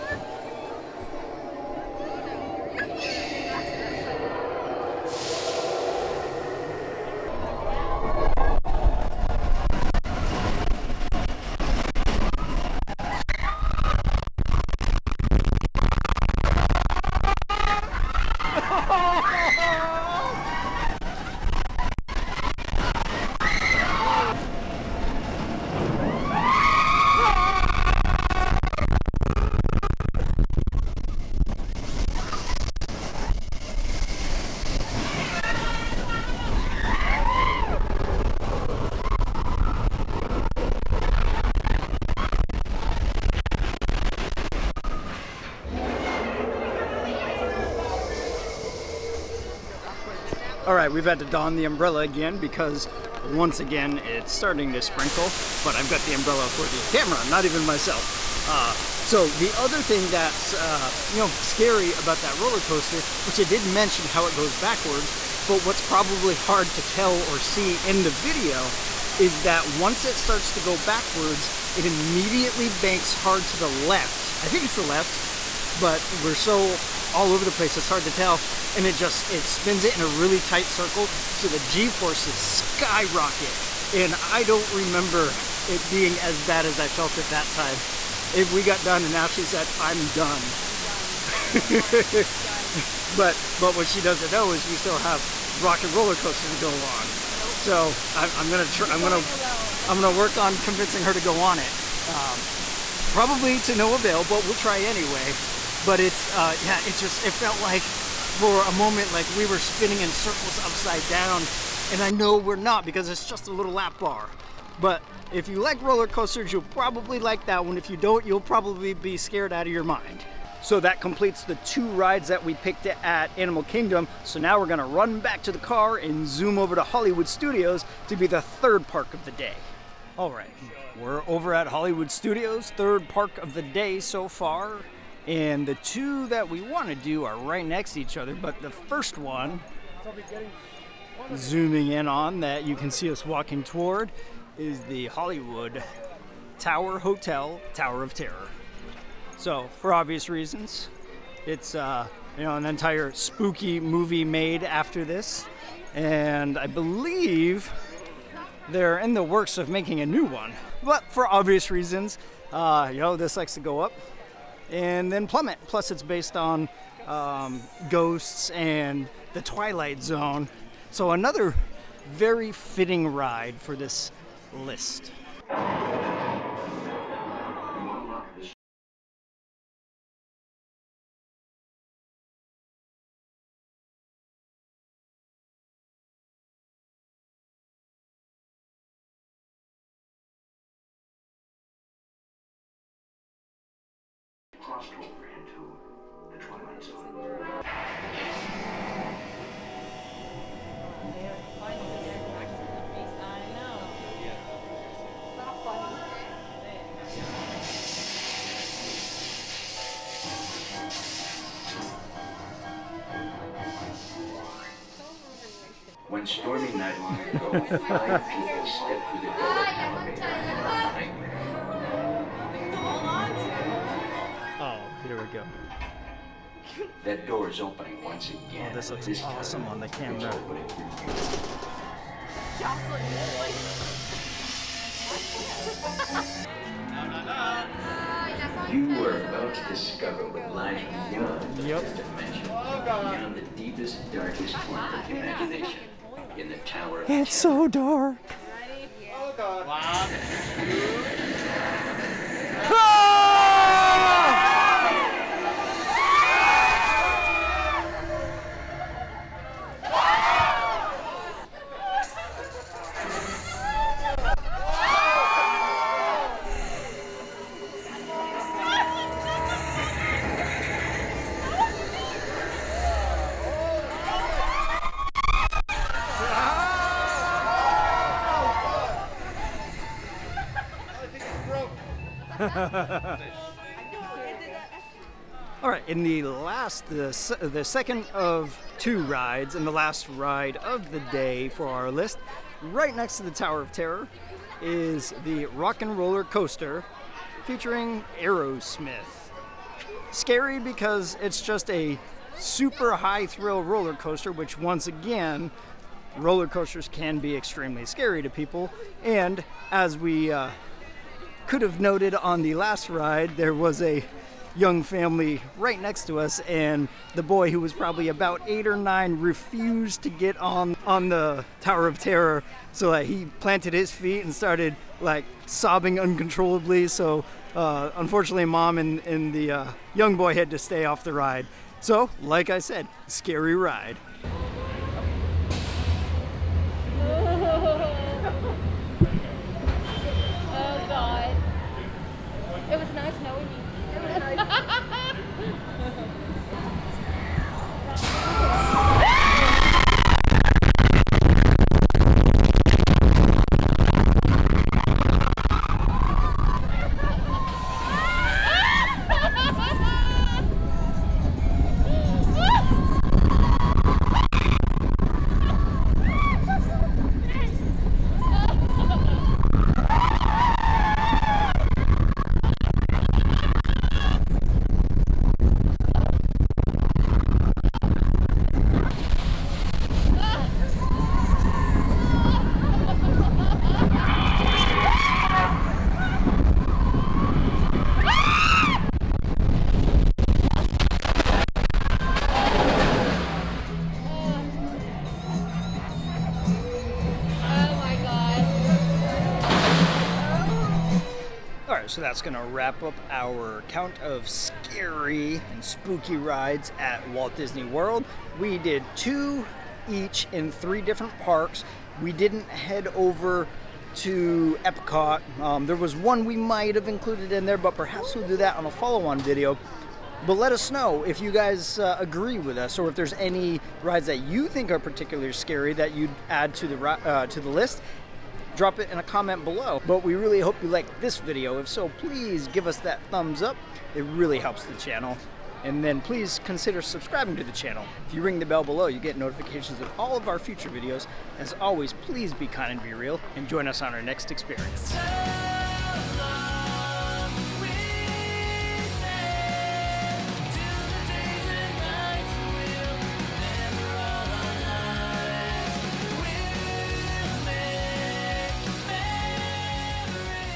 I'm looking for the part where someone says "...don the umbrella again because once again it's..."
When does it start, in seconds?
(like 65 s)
51 s.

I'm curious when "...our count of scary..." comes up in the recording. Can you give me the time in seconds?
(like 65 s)
403 s.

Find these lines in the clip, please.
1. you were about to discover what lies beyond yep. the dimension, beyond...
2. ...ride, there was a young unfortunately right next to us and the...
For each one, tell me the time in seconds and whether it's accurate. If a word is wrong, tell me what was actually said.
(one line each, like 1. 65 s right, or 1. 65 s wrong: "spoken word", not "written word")
1. 238 s right
2. 312 s wrong: "family", not "unfortunately".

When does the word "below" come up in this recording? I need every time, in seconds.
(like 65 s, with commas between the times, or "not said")
429 s, 438 s.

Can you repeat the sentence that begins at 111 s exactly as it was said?
And I know we're not because it's just a little lap bar.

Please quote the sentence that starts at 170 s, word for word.
So, another very fitting ride for this list.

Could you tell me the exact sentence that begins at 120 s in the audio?
So that completes the two rides that we picked at Animal Kingdom.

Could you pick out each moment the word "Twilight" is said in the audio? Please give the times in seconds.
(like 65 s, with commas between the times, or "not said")
169 s, 196 s.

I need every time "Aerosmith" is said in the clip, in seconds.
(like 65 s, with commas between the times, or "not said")
298 s.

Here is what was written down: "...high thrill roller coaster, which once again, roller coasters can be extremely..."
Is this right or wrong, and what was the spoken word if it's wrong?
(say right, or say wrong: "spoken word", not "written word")
right.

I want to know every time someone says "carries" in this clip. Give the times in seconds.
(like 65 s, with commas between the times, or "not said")
not said.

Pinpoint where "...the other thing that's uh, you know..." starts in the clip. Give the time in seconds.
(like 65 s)
59 s.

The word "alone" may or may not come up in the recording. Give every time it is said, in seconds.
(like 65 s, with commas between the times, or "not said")
99 s.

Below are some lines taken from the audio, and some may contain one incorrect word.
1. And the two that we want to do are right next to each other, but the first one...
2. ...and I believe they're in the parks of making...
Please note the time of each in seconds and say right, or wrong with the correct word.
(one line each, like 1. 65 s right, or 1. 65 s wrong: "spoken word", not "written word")
1. 135 s right
2. 155 s wrong: "works", not "parks".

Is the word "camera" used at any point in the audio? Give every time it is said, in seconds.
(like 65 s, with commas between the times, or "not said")
56 s, 229 s.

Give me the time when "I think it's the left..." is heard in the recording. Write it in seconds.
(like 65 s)
74 s.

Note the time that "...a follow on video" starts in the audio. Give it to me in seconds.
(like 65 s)
418 s.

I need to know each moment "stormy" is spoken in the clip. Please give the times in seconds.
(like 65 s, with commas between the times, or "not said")
216 s.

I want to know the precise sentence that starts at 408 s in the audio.
We did two each in three different parks.